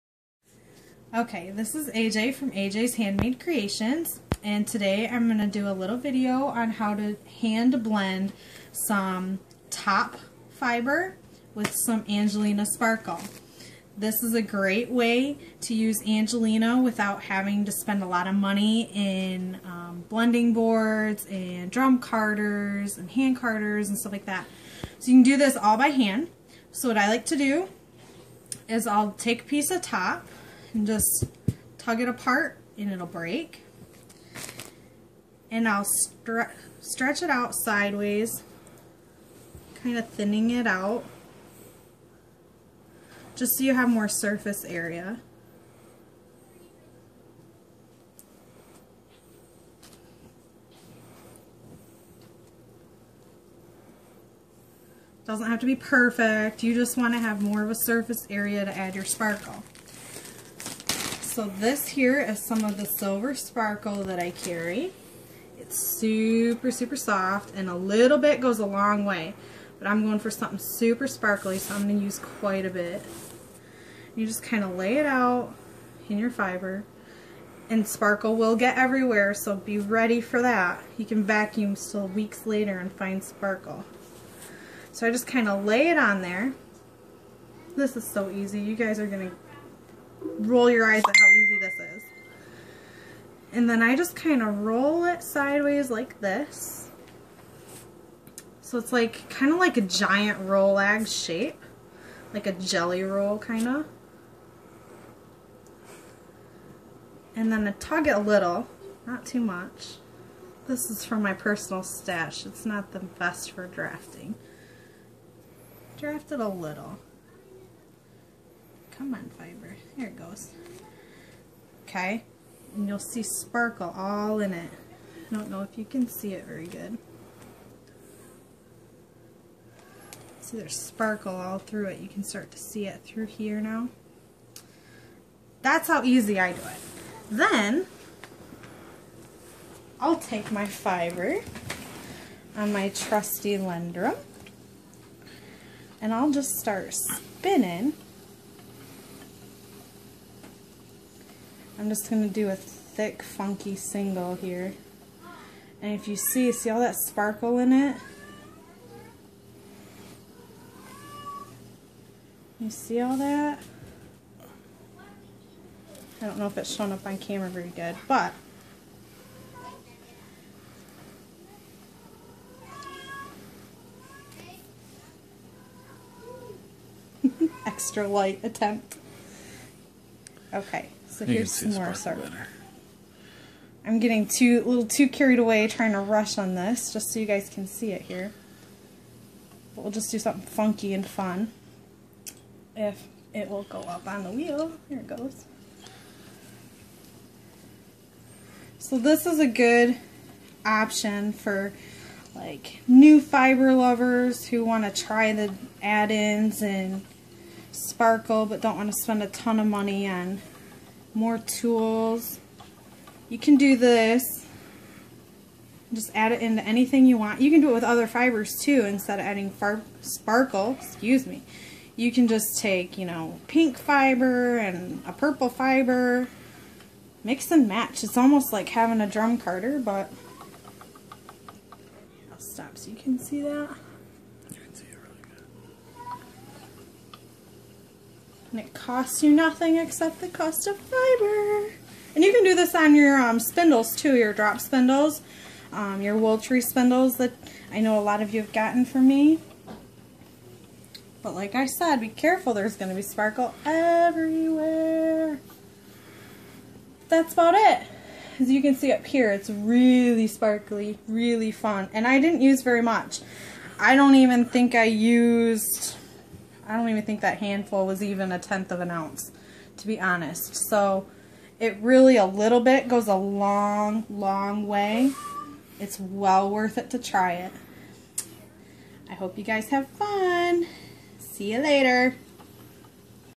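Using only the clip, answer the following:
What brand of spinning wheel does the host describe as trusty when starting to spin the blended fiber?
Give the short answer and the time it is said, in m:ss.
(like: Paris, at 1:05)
Lendrum, at 2:23.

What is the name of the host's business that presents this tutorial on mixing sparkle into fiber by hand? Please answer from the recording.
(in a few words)
AJ's Handmade Creations.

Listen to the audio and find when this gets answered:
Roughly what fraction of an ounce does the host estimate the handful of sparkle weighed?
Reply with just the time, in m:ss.
4:28.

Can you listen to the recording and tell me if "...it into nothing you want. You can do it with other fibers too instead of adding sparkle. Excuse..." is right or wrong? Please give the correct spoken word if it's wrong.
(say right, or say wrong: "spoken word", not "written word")
wrong: "anything", not "nothing".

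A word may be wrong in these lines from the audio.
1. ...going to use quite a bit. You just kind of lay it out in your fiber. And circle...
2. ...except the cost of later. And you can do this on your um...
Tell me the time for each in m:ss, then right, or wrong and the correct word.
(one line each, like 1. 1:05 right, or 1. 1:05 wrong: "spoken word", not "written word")
1. 1:11 wrong: "sparkle", not "circle"
2. 3:59 wrong: "fiber", not "later".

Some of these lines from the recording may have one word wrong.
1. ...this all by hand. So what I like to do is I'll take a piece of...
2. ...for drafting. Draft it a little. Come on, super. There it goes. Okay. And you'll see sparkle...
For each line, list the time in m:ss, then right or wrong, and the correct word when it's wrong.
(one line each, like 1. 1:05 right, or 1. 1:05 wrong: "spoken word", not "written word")
1. 0:25 right
2. 1:53 wrong: "fiber", not "super".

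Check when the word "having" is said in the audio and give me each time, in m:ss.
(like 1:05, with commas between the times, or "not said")
0:17, 3:48.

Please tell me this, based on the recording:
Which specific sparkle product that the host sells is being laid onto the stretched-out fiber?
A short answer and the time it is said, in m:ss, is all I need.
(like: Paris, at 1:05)
Silver Sparkle, at 1:02.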